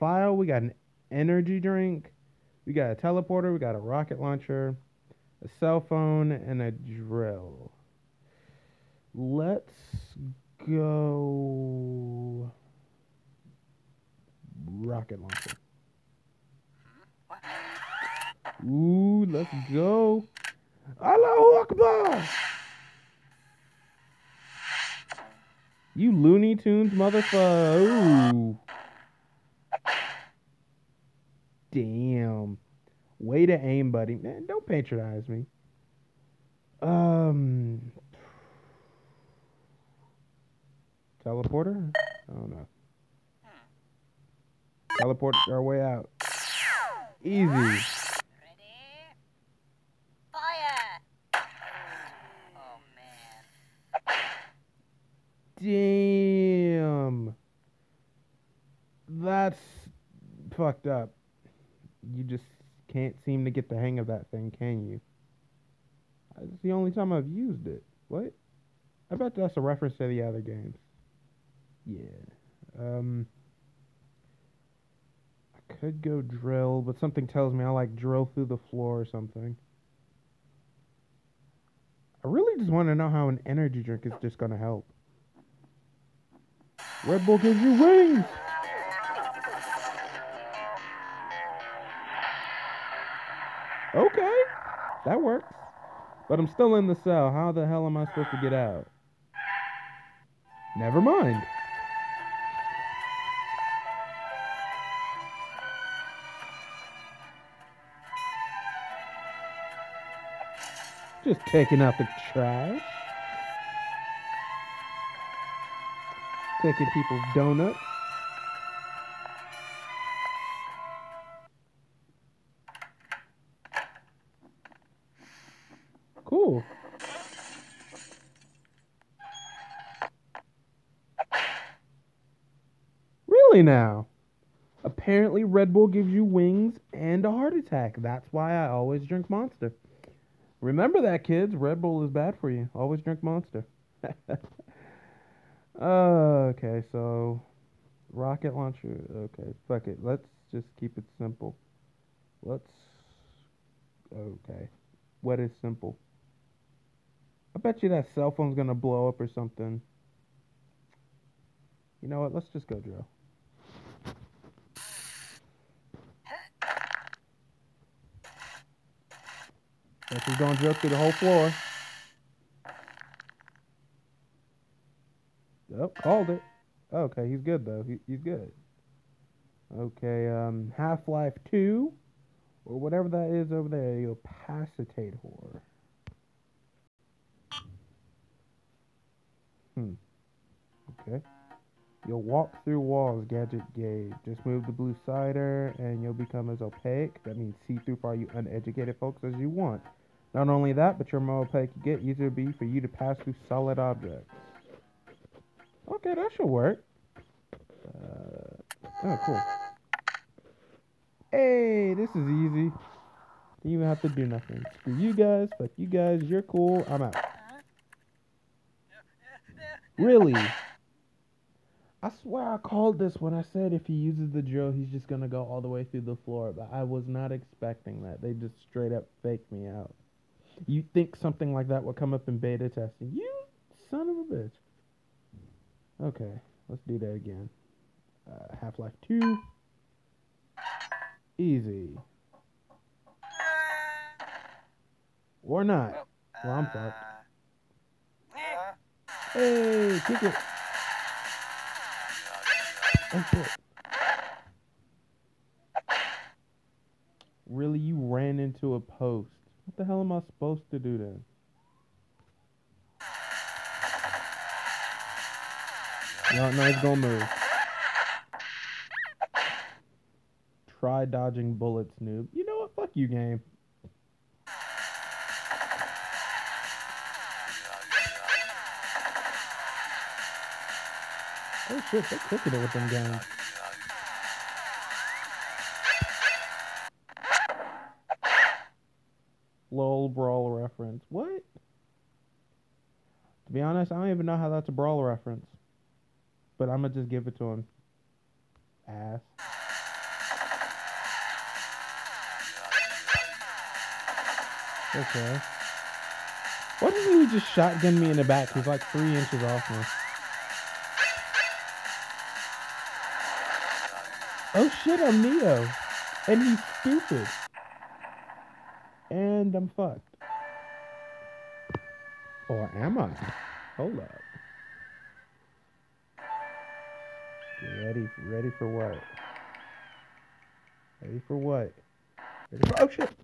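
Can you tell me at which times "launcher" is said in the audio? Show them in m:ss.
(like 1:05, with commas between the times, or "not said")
0:04, 0:15, 2:28.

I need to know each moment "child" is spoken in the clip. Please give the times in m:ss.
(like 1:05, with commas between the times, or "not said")
not said.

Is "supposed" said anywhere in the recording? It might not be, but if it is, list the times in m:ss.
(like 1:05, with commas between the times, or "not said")
1:38, 4:20.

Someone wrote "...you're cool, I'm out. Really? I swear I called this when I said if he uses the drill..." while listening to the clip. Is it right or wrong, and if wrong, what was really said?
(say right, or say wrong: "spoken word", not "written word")
right.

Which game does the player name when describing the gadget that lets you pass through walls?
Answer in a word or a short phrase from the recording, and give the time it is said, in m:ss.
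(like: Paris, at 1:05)
Half Life 2, at 3:00.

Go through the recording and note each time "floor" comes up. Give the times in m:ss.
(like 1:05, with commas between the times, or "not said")
1:18, 2:51, 3:46.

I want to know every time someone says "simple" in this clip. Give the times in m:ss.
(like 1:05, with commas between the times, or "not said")
2:31, 2:35.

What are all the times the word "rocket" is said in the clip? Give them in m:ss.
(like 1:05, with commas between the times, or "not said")
0:03, 0:14, 2:28.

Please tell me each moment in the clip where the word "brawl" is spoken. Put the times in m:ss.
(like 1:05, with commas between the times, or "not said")
4:50, 4:54.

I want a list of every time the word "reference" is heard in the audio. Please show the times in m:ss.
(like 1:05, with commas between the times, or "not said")
1:09, 4:50, 4:55.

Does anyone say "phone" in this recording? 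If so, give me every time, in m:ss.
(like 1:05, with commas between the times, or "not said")
0:05, 2:38.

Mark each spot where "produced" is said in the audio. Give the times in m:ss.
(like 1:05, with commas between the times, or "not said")
not said.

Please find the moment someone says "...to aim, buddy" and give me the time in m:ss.
0:33.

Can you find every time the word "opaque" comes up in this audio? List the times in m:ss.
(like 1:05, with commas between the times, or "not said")
3:16, 3:21.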